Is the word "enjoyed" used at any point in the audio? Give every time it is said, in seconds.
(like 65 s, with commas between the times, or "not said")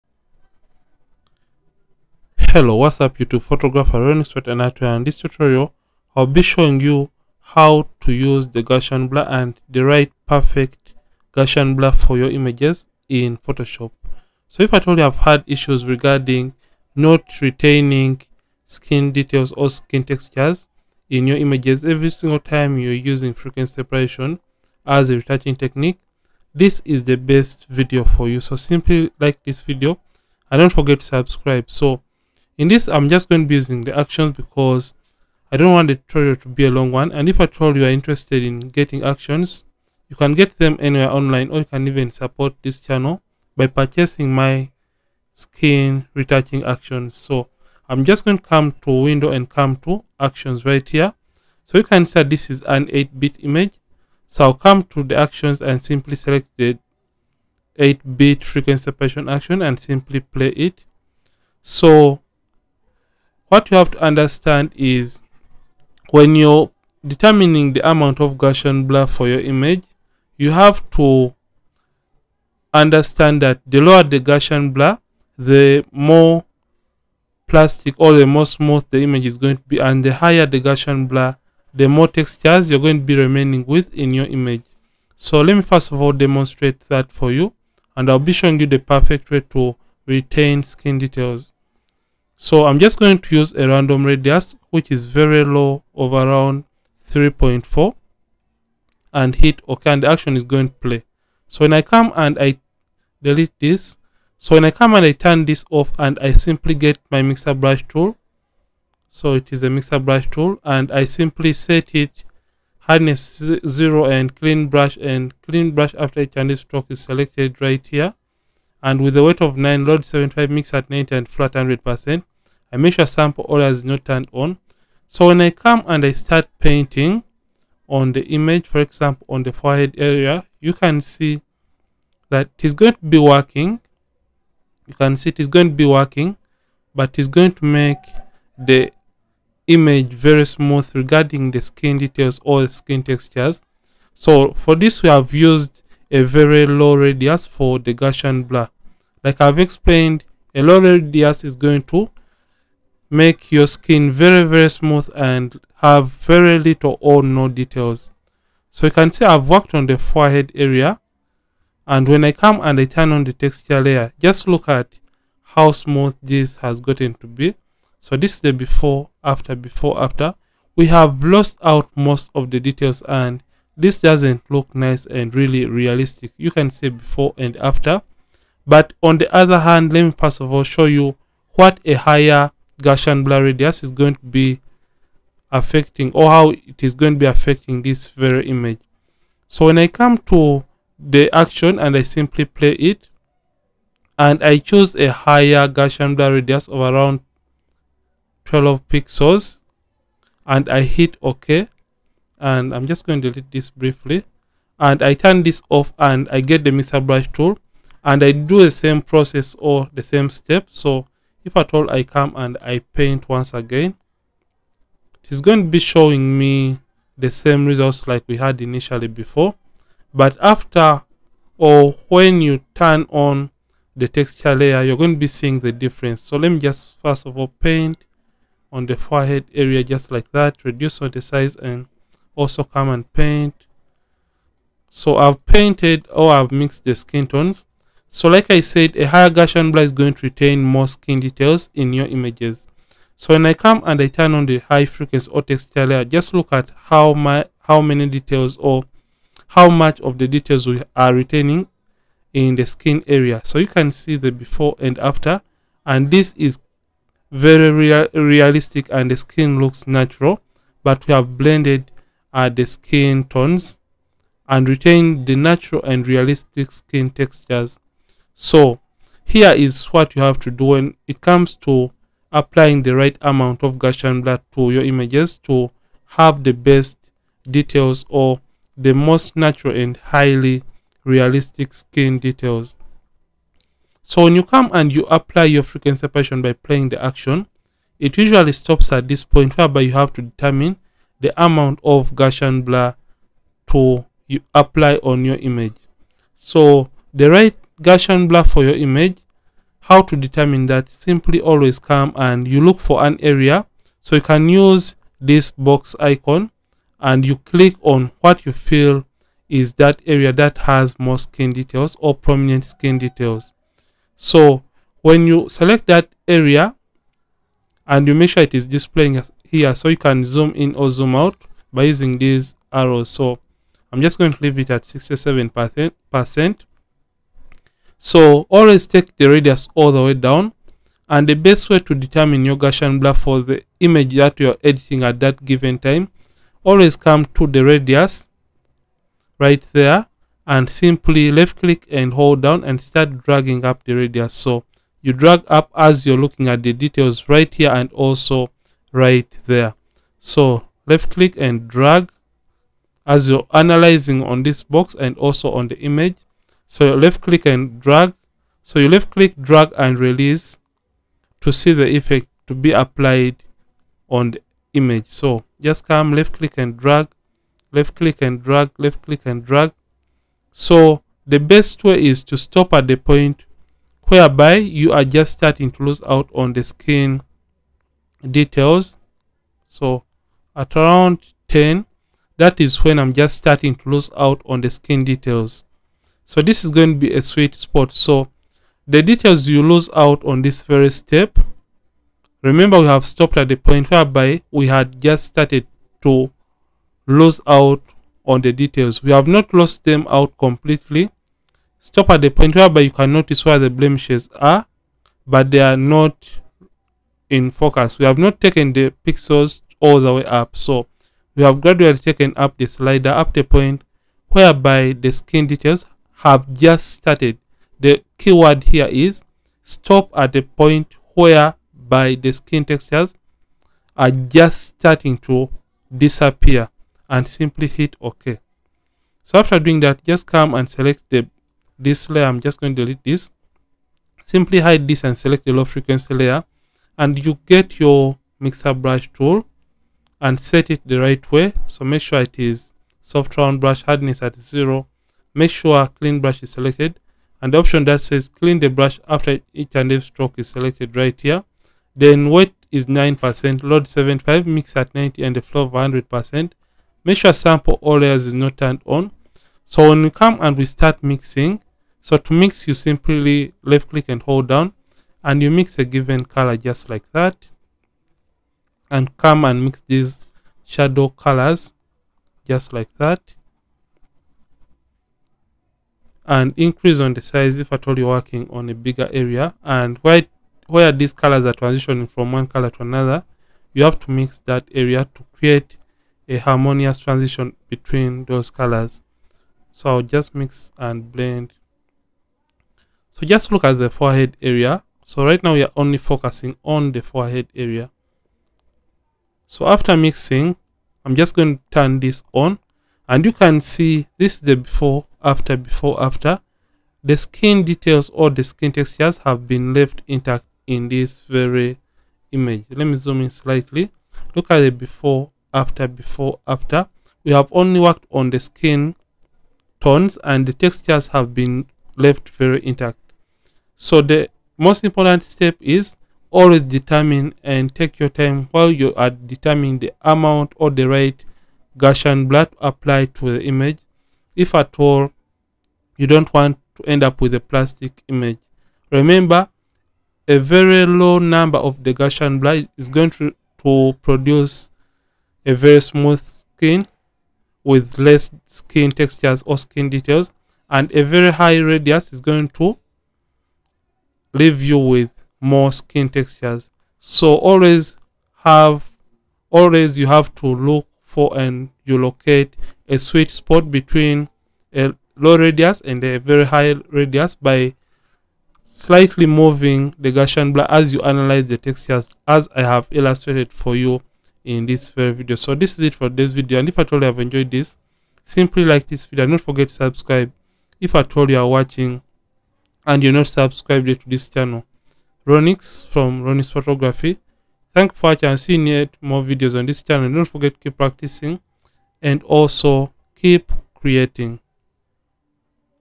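577 s.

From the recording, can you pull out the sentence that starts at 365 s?
So just come left click and drag, left click and drag, left click and drag.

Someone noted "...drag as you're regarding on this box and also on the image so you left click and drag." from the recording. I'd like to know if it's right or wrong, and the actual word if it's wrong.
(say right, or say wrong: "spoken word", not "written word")
wrong: "analyzing", not "regarding".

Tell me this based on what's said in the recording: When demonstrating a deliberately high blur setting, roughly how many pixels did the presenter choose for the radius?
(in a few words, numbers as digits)
12.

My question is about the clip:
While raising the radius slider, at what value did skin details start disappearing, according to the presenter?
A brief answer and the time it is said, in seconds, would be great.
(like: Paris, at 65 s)
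10, at 381 s.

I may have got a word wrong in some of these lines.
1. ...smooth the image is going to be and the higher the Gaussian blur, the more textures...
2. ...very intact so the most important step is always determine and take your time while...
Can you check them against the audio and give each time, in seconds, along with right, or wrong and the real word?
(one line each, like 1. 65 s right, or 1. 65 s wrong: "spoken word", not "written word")
1. 78 s right
2. 522 s right.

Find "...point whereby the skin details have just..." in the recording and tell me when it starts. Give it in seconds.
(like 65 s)
413 s.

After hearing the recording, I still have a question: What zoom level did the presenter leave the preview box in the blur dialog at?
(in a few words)
67 percent.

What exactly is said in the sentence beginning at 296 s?
So the right Gaussian blur for your image.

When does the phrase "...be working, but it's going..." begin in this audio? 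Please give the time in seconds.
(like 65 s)
135 s.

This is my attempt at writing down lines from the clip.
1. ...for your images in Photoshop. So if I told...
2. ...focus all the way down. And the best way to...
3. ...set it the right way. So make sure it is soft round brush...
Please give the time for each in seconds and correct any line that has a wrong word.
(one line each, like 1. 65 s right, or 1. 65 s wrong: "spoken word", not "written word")
1. 11 s right
2. 329 s wrong: "radius", not "focus"
3. 440 s right.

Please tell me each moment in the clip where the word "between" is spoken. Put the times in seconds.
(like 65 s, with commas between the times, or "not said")
487 s, 563 s.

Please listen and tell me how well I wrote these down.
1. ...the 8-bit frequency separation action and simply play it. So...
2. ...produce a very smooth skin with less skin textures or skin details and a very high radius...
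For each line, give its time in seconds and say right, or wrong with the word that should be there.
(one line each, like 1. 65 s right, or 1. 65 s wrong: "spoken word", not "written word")
1. 56 s right
2. 544 s right.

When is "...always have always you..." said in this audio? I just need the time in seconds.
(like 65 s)
557 s.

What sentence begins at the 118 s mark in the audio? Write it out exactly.
And with the weight of 9, load 75, mix at 90 and flat 100%.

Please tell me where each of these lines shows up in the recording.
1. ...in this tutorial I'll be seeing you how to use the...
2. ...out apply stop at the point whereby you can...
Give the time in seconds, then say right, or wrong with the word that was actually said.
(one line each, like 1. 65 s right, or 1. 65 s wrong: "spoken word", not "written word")
1. 4 s wrong: "showing", not "seeing"
2. 400 s wrong: "completely", not "apply".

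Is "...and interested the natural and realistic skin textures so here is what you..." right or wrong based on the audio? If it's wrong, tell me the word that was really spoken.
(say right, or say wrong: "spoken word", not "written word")
wrong: "retained", not "interested".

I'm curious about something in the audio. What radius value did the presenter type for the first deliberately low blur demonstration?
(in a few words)
3.4.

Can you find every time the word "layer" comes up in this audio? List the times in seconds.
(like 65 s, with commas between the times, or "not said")
163 s, 224 s, 245 s, 432 s, 436 s, 457 s.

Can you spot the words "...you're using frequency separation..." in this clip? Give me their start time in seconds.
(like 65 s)
22 s.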